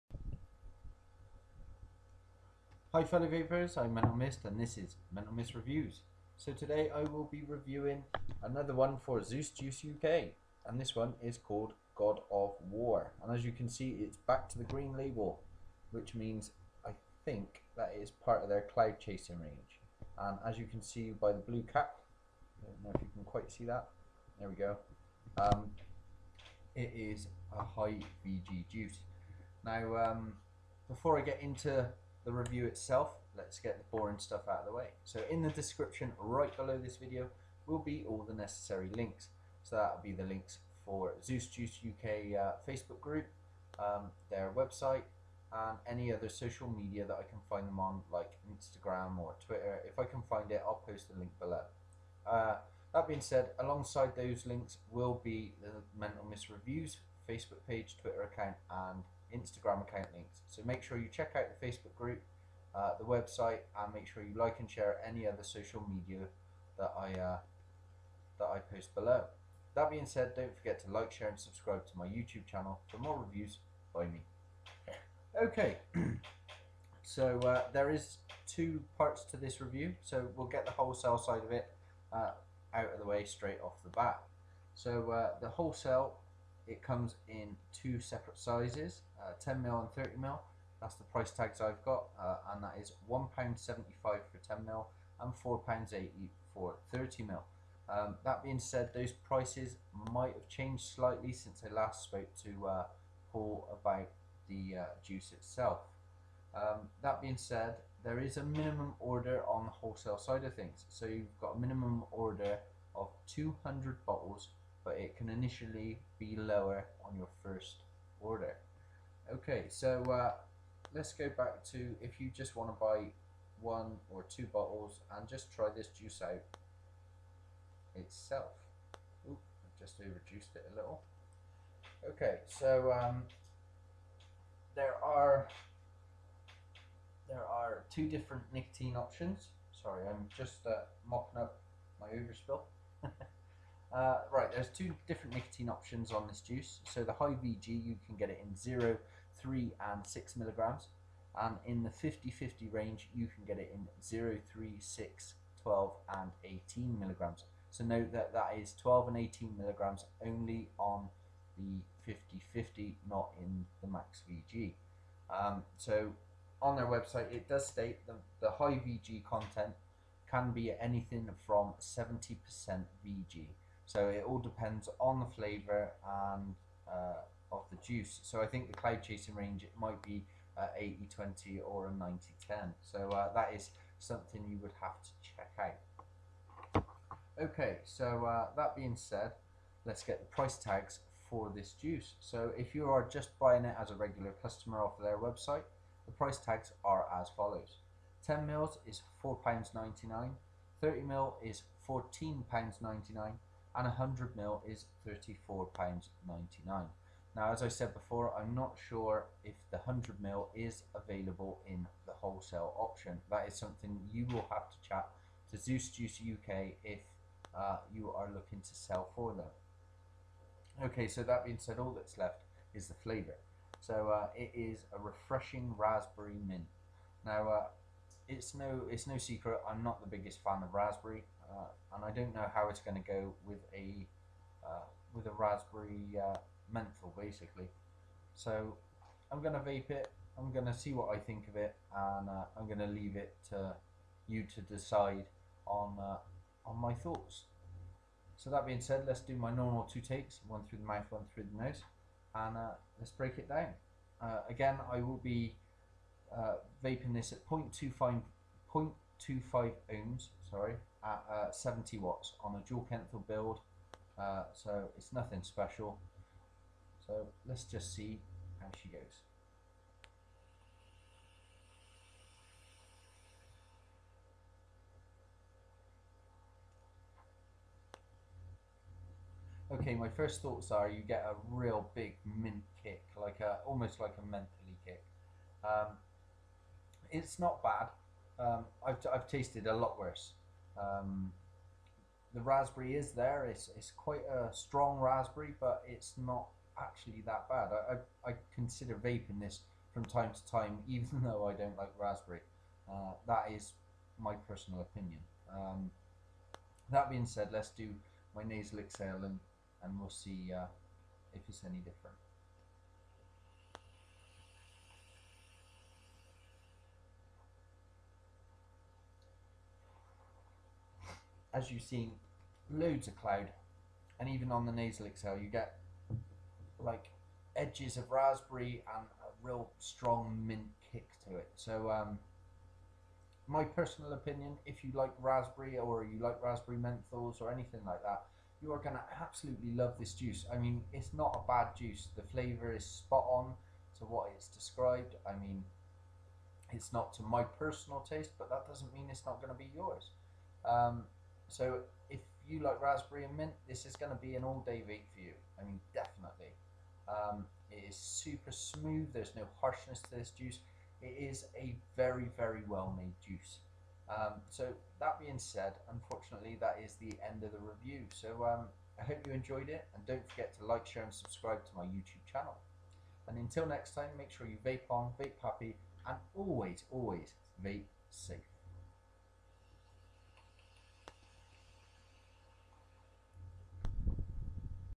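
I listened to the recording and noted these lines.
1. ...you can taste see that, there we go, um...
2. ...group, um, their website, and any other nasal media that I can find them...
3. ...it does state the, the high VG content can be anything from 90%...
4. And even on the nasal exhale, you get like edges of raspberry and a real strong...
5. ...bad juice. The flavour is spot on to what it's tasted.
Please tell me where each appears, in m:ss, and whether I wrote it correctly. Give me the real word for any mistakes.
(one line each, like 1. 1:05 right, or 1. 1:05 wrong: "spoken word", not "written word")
1. 0:22 wrong: "quite", not "taste"
2. 0:42 wrong: "social", not "nasal"
3. 2:47 wrong: "70", not "90"
4. 5:24 right
5. 5:41 wrong: "described", not "tasted".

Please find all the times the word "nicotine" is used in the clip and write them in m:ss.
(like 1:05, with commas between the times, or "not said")
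2:18, 2:25.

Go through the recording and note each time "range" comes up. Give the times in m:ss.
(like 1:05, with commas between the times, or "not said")
0:19, 2:32, 2:59.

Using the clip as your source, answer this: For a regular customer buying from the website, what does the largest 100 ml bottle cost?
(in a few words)
£34.99.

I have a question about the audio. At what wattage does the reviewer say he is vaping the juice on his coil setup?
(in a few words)
70 watts.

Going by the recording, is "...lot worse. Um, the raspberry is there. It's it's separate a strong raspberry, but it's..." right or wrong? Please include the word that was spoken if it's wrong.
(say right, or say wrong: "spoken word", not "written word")
wrong: "quite", not "separate".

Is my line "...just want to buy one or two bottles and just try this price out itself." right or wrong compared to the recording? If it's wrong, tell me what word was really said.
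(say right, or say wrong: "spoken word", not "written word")
wrong: "juice", not "price".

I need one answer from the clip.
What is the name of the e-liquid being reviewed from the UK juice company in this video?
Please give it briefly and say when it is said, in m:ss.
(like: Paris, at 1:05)
God of War, at 0:11.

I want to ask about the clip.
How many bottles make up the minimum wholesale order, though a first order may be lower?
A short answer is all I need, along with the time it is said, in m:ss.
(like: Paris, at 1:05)
200, at 1:53.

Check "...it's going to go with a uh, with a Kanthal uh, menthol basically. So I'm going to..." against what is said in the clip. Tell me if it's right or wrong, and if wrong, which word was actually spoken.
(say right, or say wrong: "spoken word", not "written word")
wrong: "Raspberry", not "Kanthal".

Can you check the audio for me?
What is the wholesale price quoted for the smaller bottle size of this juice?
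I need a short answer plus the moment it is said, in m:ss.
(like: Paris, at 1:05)
£1.75, at 1:33.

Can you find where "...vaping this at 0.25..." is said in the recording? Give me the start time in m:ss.
4:16.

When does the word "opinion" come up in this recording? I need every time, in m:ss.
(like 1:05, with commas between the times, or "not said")
5:04, 5:34.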